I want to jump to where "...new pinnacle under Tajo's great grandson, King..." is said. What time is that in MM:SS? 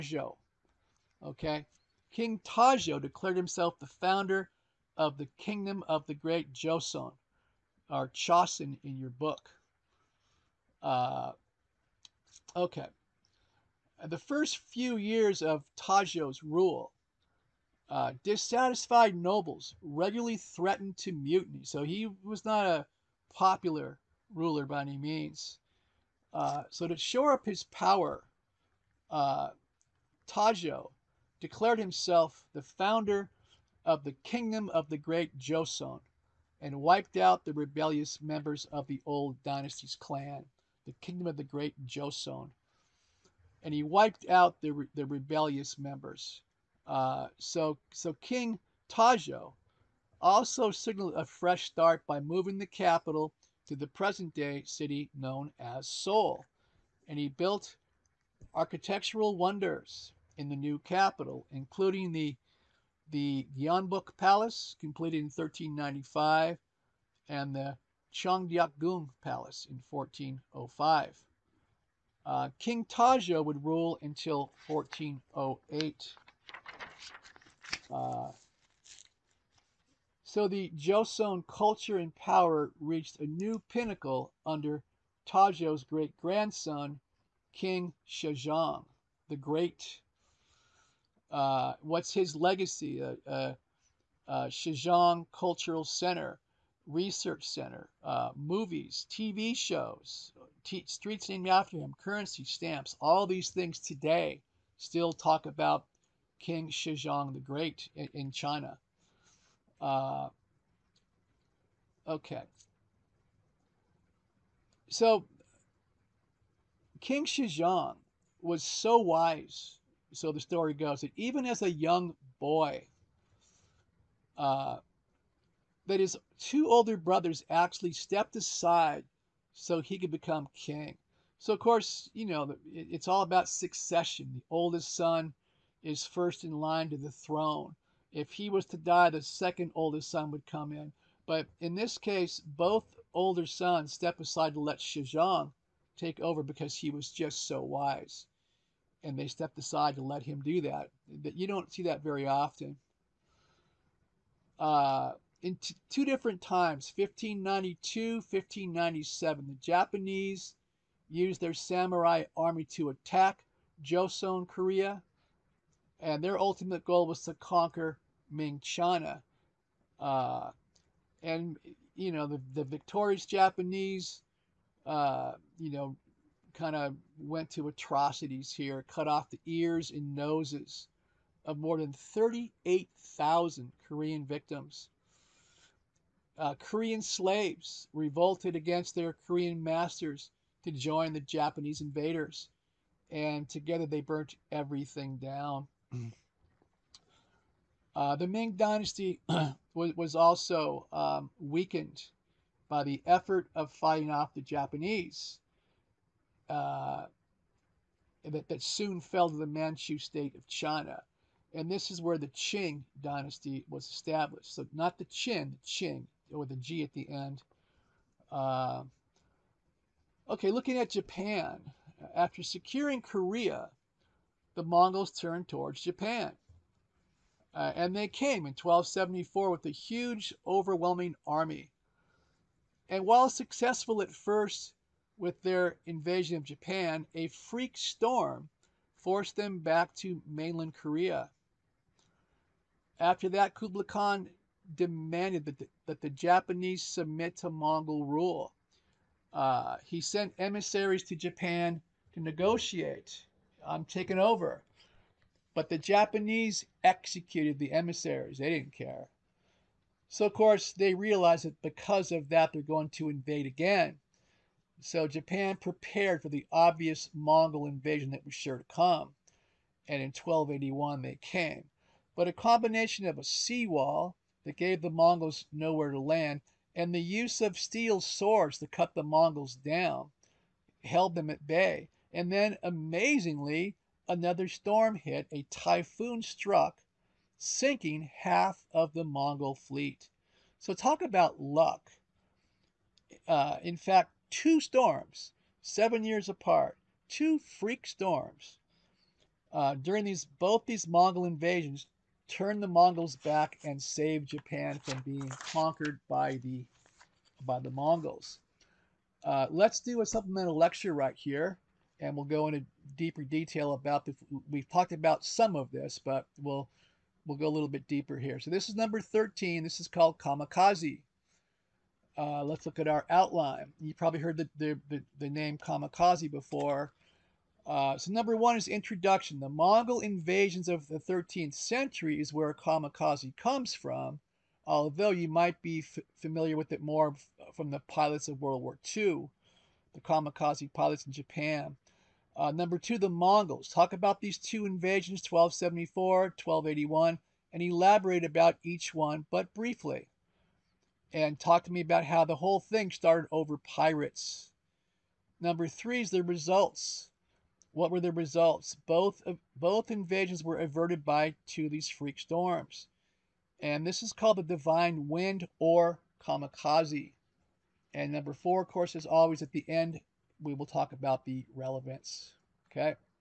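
01:23.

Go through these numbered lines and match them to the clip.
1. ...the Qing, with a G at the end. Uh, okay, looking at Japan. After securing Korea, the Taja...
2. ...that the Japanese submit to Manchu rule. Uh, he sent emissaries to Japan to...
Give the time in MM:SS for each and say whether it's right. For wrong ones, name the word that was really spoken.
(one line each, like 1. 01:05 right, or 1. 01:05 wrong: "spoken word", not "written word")
1. 03:35 wrong: "Mongols", not "Taja"
2. 04:05 wrong: "Mongol", not "Manchu".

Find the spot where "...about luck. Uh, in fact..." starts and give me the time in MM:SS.
04:51.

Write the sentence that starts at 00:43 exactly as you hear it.
And he wiped out the, the rebellious members.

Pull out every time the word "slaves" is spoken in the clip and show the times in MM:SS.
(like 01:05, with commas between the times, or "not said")
03:07.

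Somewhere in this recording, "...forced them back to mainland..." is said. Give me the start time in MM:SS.
03:58.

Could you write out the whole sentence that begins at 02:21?
But in this case, both older sons step aside to let Sejong take over because he was just so wise.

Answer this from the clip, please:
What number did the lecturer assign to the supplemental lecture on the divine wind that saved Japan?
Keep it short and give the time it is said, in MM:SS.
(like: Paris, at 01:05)
13, at 05:18.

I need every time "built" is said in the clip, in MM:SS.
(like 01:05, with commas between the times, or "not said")
00:57.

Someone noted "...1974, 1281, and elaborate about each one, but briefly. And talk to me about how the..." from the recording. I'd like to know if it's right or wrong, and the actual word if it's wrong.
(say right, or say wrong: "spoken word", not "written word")
wrong: "1274", not "1974".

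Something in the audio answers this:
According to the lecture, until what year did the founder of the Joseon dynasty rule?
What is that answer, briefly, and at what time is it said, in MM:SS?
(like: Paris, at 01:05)
1408, at 01:14.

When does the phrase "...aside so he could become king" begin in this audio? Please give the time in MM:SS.
02:08.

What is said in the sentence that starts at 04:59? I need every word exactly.
Uh, during these both these Mongol invasions, turned the Mongols back and saved Japan from being conquered by the by the Mongols.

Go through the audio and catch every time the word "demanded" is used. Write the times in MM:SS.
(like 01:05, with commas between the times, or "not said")
04:04.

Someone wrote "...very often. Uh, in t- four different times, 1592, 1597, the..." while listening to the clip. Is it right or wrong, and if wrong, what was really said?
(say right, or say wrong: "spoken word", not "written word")
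wrong: "two", not "four".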